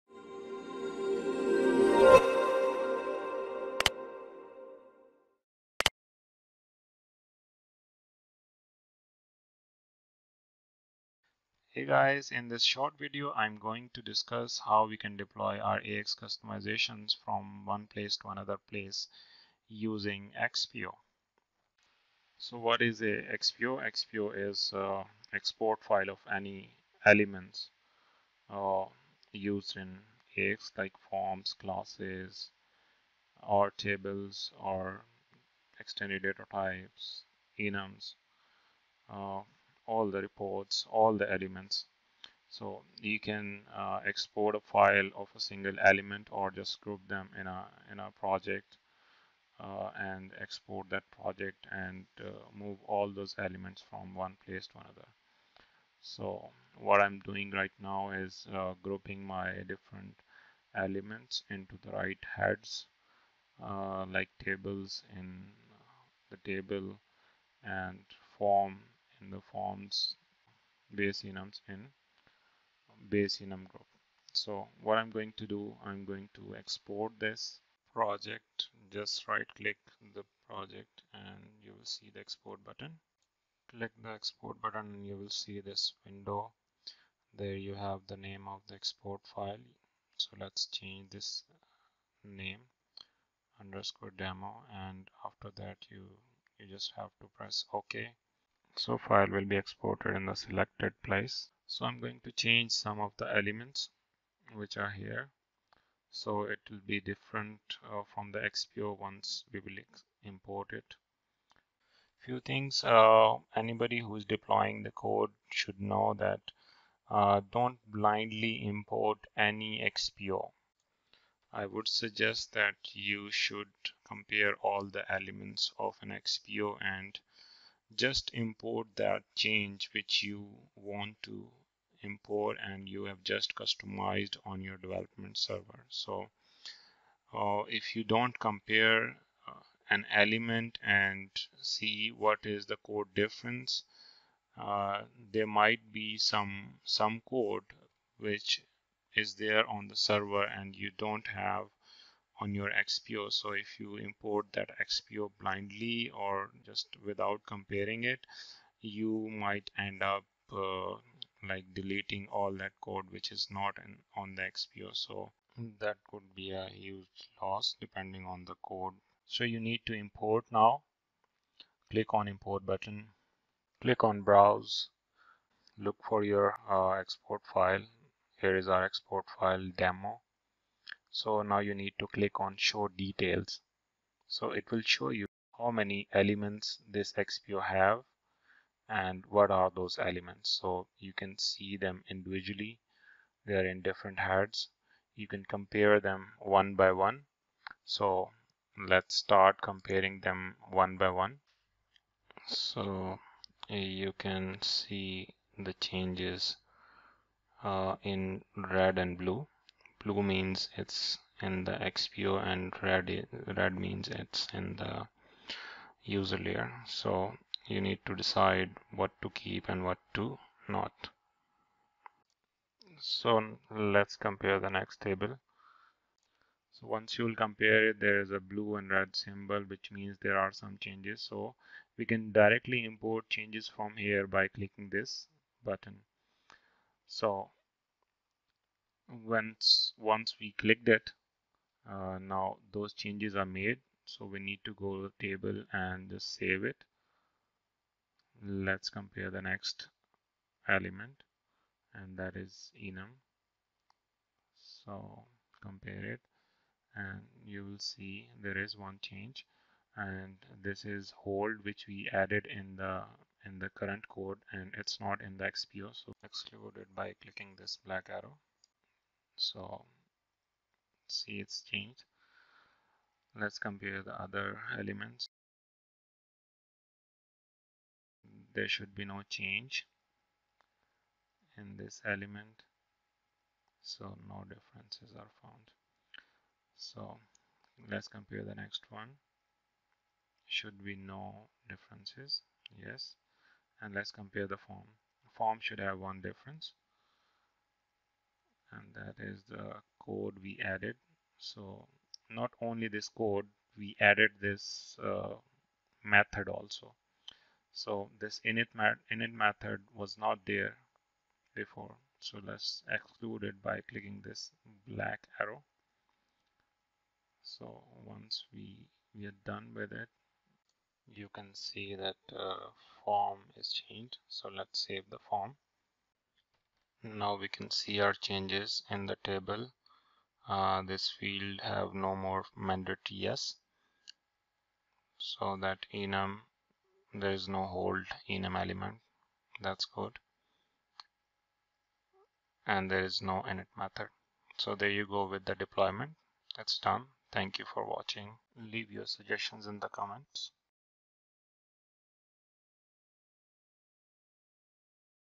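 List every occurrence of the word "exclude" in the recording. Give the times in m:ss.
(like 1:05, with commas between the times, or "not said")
4:26, 5:12.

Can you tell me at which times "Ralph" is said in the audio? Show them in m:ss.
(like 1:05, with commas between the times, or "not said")
not said.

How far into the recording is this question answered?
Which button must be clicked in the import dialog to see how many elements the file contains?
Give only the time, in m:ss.
3:02.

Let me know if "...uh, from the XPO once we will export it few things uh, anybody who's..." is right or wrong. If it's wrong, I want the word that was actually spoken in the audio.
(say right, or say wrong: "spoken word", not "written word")
wrong: "import", not "export".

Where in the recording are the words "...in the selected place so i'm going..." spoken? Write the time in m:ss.
1:40.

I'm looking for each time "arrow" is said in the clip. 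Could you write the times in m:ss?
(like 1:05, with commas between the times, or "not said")
4:28, 5:15.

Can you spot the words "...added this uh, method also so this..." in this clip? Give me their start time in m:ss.
5:03.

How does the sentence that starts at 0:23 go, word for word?
XPO is uh, export file of any elements uh, used in AX like forms, classes, or tables, or extended data types, enums.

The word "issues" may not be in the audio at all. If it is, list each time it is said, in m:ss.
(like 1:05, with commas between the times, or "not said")
not said.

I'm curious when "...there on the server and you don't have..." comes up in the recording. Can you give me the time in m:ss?
2:29.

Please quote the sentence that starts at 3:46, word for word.
So once you will compare it, there is a blue and red symbol, which means there are some changes.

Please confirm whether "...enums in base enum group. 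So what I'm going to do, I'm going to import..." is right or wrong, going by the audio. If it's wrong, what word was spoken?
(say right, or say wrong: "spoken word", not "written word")
wrong: "export", not "import".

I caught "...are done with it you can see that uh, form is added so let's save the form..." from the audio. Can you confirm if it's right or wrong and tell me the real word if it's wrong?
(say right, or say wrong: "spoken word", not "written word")
wrong: "changed", not "added".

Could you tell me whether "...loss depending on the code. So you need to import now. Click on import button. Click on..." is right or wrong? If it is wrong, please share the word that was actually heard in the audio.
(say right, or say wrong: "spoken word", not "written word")
right.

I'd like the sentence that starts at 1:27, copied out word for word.
There you have the name of the export file.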